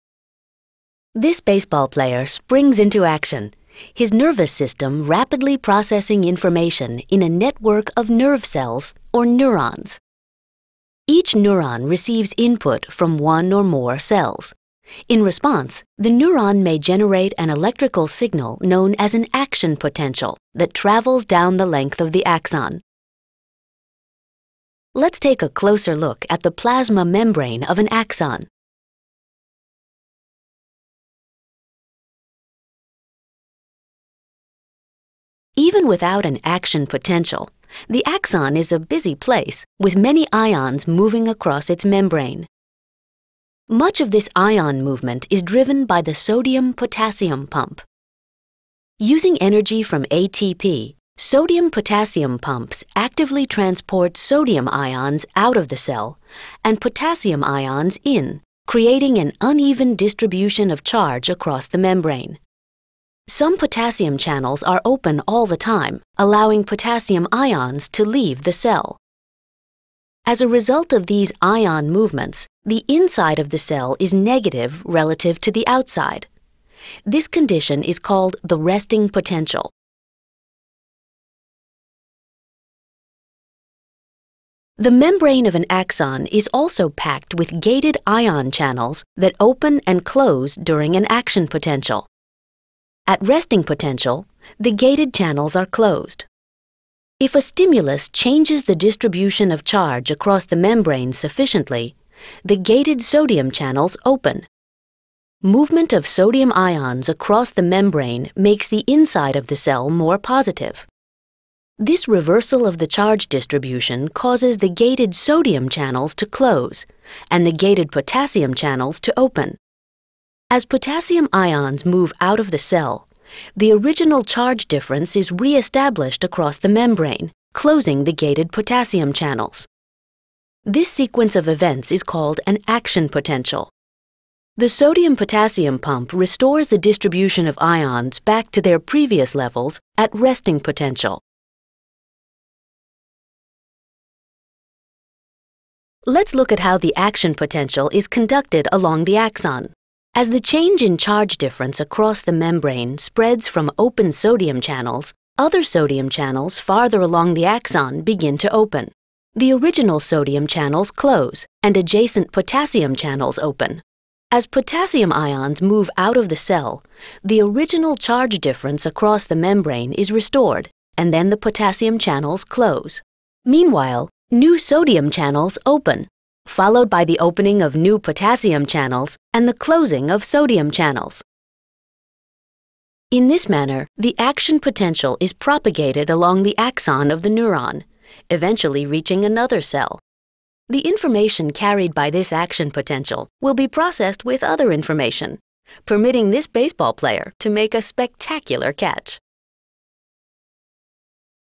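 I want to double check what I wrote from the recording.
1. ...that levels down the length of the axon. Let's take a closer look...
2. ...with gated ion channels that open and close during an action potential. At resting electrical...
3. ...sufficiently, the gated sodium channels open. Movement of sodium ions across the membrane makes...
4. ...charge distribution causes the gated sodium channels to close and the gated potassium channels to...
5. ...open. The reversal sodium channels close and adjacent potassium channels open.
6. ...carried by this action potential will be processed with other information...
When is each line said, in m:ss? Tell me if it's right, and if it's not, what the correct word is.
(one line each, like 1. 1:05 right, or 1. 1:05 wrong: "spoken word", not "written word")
1. 0:20 wrong: "travels", not "levels"
2. 1:27 wrong: "potential", not "electrical"
3. 1:41 right
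4. 1:52 right
5. 2:38 wrong: "original", not "reversal"
6. 3:11 right.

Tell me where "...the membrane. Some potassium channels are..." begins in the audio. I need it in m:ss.
1:01.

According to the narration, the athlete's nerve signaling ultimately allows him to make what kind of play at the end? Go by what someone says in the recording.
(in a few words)
a spectacular catch.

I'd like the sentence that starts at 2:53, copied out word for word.
Meanwhile, new sodium channels open followed by the opening of new potassium channels and the closing of sodium channels.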